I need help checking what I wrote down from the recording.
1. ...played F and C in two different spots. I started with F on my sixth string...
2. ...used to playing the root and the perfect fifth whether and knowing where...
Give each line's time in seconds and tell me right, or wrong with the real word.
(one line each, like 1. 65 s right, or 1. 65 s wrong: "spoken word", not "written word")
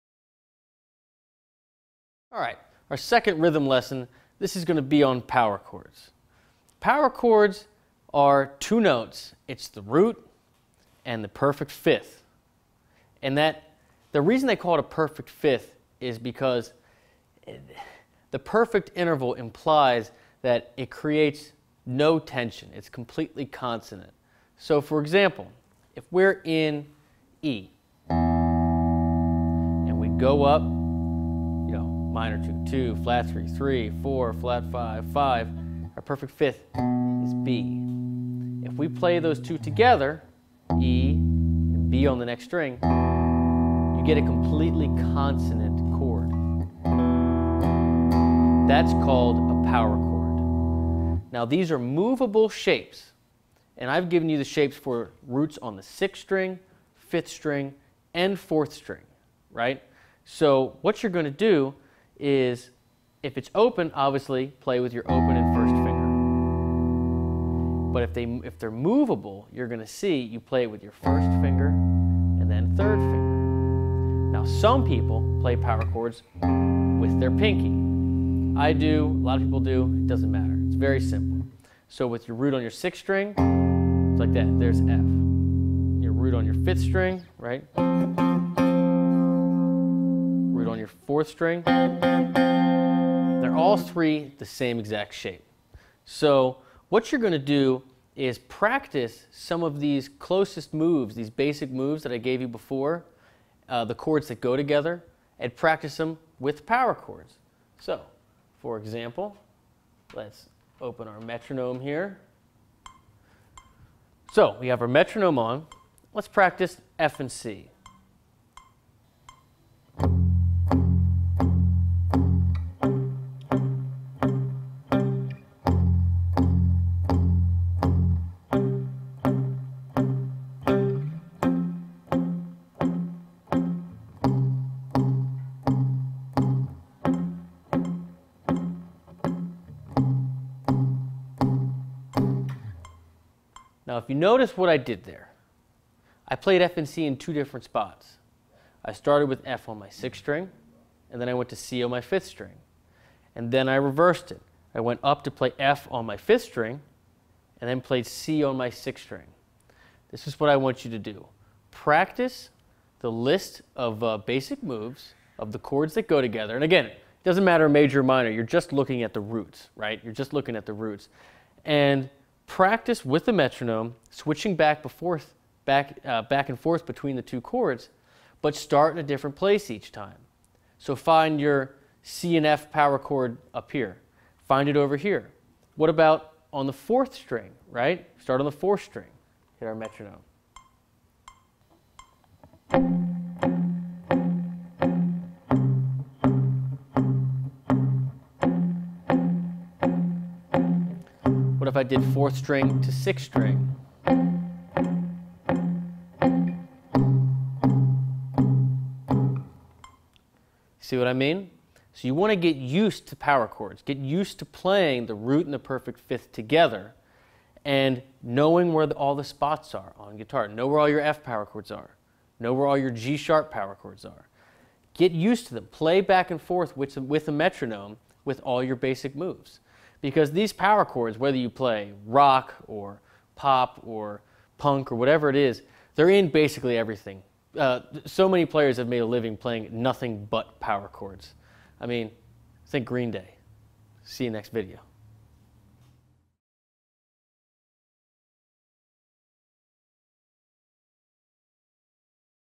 1. 146 s right
2. 213 s wrong: "together", not "whether".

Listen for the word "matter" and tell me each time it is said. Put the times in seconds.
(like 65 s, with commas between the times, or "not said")
80 s, 167 s.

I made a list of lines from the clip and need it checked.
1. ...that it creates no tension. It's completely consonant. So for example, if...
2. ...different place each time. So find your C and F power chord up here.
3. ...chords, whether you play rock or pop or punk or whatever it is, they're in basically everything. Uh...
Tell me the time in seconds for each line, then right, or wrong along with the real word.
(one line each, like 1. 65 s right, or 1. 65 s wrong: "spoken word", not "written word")
1. 20 s right
2. 179 s right
3. 230 s right.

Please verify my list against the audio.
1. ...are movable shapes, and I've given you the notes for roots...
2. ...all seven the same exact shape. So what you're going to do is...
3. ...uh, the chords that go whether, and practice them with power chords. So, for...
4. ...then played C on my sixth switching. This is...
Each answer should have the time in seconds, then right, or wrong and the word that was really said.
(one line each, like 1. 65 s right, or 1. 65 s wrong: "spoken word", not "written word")
1. 51 s wrong: "shapes", not "notes"
2. 93 s wrong: "three", not "seven"
3. 103 s wrong: "together", not "whether"
4. 157 s wrong: "string", not "switching".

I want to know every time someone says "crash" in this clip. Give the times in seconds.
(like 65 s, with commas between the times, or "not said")
not said.